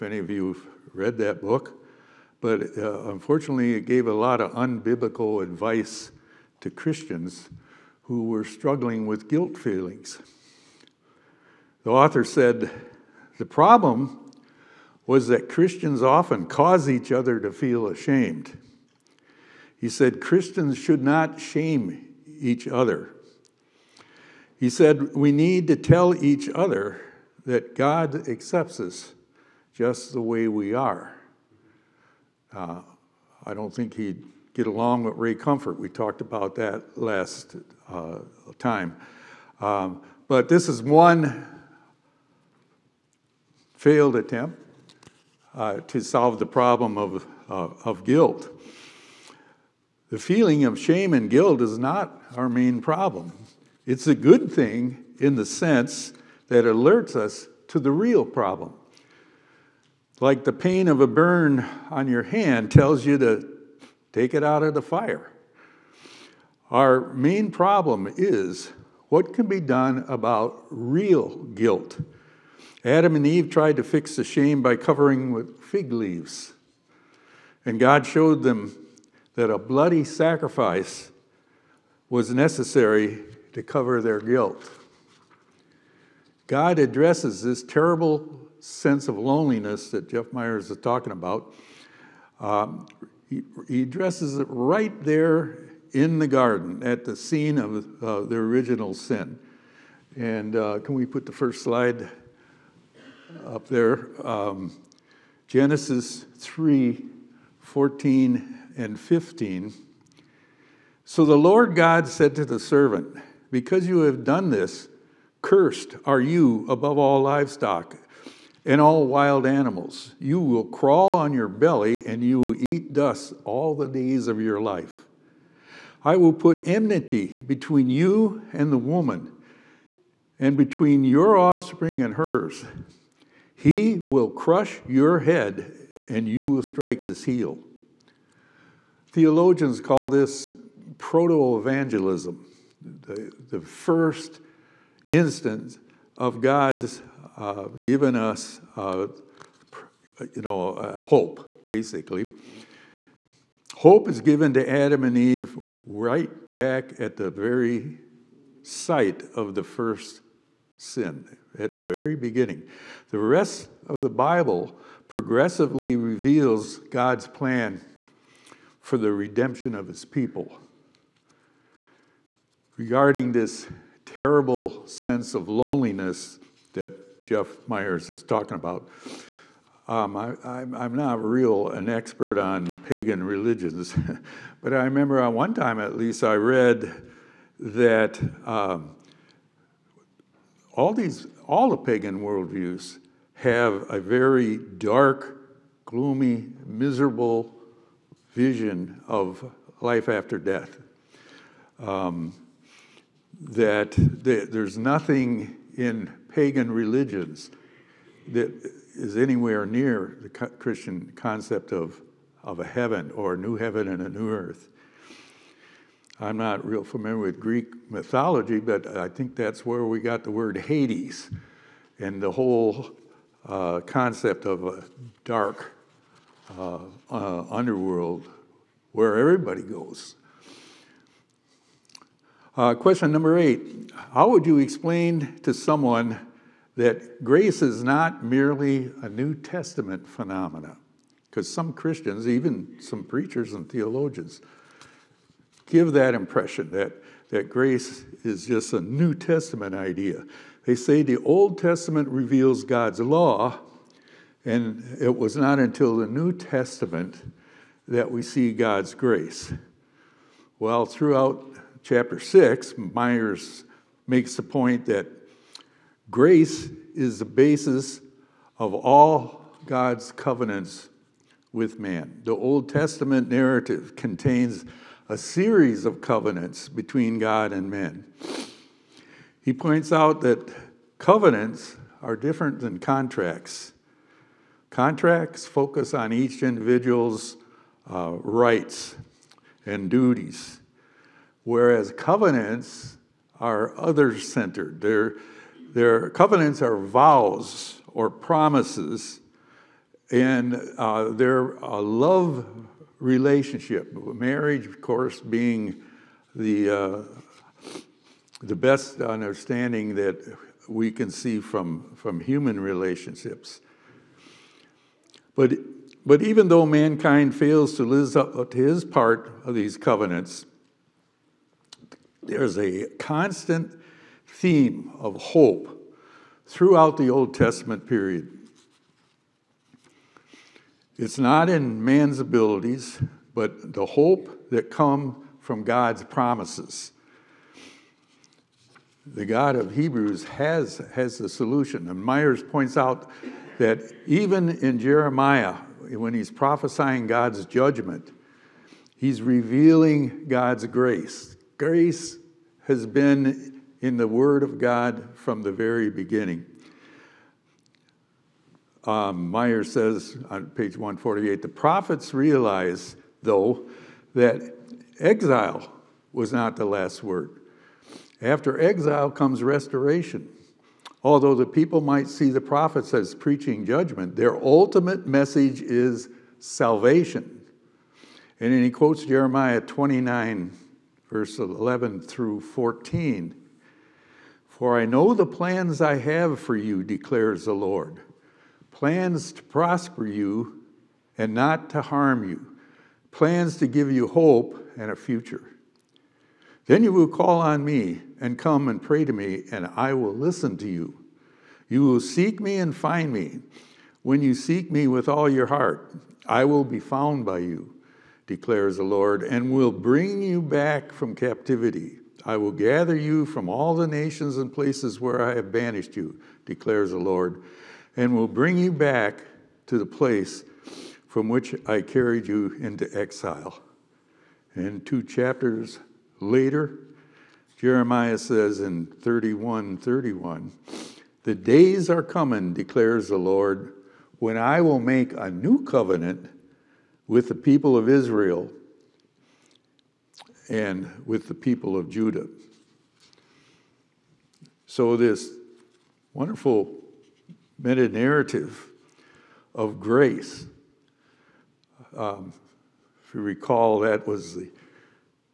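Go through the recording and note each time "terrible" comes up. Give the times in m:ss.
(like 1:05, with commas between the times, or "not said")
1:27, 2:54.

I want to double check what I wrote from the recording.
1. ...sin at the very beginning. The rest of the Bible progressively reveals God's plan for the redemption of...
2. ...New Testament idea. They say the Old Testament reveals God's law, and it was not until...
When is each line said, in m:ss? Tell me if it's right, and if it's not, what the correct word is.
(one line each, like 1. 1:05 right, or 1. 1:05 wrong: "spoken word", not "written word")
1. 2:40 right
2. 4:08 right.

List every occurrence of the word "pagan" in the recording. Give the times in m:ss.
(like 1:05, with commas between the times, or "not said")
3:02, 3:11, 3:26.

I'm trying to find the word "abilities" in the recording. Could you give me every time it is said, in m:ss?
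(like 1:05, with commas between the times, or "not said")
5:32.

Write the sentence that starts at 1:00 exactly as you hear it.
Like the pain of a burn on your hand tells you to take it out of the fire.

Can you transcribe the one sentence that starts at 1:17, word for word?
And God showed them that a bloody sacrifice was necessary to cover their guilt.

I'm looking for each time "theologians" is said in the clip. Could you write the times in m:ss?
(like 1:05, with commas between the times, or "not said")
2:19, 4:03.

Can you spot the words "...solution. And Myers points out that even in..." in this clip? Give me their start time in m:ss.
5:41.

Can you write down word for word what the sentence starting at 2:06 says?
I will put enmity between you and the woman, and between your offspring and hers.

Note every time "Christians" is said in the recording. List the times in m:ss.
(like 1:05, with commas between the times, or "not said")
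0:06, 0:15, 0:20, 3:30, 4:01.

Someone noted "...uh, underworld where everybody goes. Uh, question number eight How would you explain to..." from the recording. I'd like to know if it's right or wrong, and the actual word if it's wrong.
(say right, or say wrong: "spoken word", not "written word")
right.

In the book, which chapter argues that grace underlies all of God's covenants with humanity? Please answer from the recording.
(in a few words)
chapter 6.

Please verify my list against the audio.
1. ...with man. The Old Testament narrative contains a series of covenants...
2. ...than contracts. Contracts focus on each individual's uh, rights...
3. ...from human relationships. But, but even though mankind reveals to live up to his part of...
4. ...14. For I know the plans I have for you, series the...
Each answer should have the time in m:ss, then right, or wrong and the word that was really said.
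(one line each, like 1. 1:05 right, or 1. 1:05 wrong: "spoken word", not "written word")
1. 4:31 right
2. 4:42 right
3. 5:11 wrong: "fails", not "reveals"
4. 6:22 wrong: "declares", not "series".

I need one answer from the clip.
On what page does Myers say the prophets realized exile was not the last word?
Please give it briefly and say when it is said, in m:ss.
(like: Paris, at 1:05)
148, at 6:00.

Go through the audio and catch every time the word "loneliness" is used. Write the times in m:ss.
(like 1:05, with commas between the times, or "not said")
1:29, 2:55.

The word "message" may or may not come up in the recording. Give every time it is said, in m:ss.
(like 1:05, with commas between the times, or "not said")
6:15.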